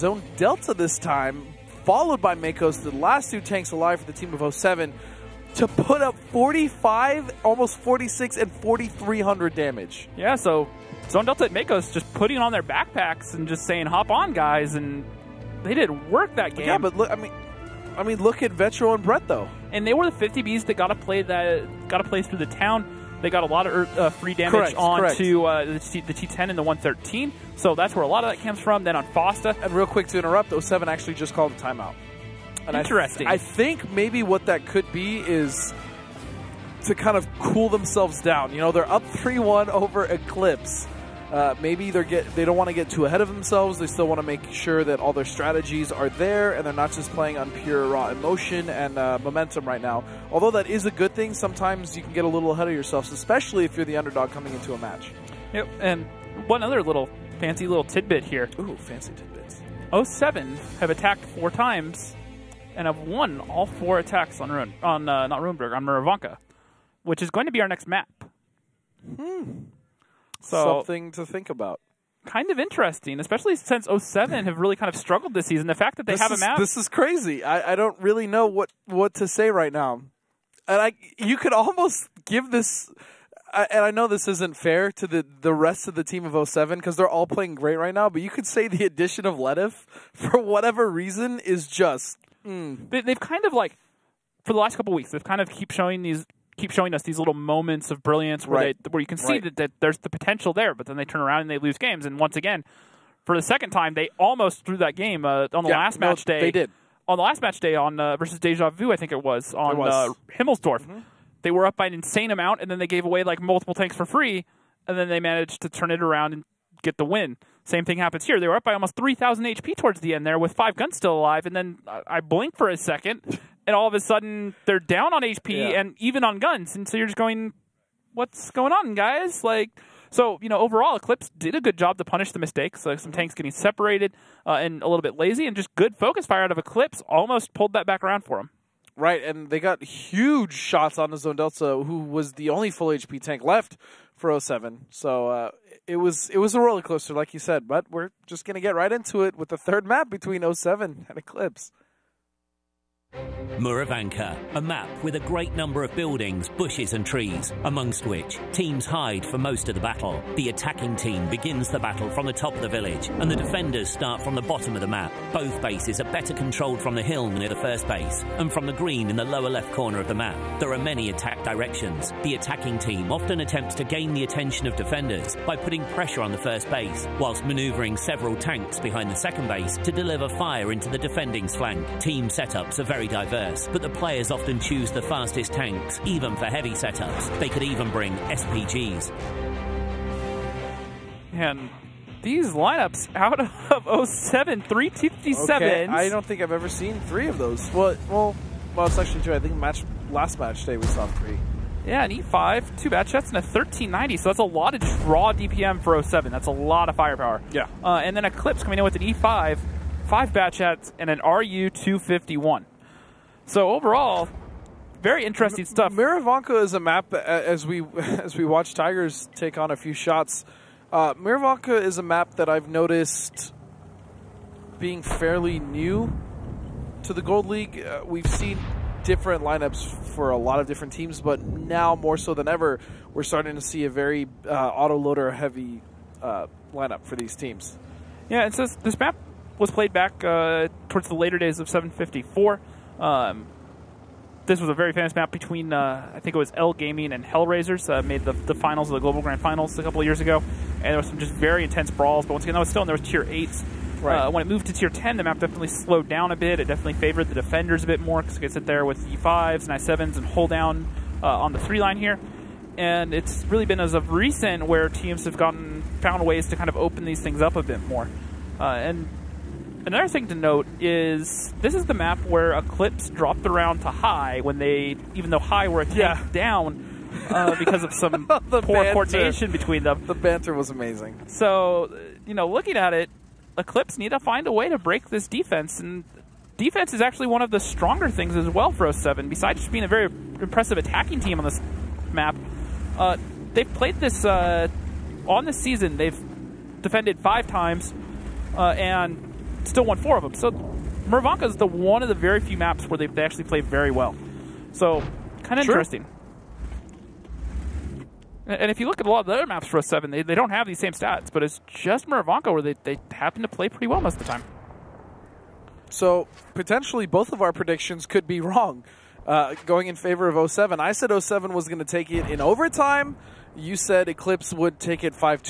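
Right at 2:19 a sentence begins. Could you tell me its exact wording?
And they got huge shots on the Zone Delta, who was the only full HP tank left for 07.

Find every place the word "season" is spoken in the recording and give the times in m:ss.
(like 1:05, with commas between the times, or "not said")
1:15, 4:55.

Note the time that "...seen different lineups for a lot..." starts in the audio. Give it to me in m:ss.
3:48.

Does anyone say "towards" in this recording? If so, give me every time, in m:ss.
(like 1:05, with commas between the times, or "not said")
1:59, 4:00.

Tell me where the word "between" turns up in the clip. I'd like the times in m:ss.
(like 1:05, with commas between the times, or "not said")
2:30, 4:05, 4:39.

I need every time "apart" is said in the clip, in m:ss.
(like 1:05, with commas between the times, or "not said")
not said.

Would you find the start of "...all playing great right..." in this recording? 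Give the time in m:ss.
1:27.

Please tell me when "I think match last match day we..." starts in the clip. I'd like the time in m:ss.
3:19.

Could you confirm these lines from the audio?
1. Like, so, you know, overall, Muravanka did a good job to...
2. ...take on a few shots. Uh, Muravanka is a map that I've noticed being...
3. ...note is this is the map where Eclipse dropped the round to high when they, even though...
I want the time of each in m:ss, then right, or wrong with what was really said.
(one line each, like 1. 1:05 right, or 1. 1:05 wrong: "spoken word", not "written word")
1. 2:09 wrong: "Eclipse", not "Muravanka"
2. 3:39 right
3. 4:30 right.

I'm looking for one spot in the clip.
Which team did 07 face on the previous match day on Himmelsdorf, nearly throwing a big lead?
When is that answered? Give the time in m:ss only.
1:48.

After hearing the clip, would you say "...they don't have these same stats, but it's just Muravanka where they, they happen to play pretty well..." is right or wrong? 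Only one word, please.
right.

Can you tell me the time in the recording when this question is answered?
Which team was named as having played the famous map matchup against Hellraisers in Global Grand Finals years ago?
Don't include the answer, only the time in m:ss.
4:06.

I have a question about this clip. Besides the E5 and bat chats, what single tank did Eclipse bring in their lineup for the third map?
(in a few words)
RU251.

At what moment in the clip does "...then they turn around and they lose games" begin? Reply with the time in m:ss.
1:40.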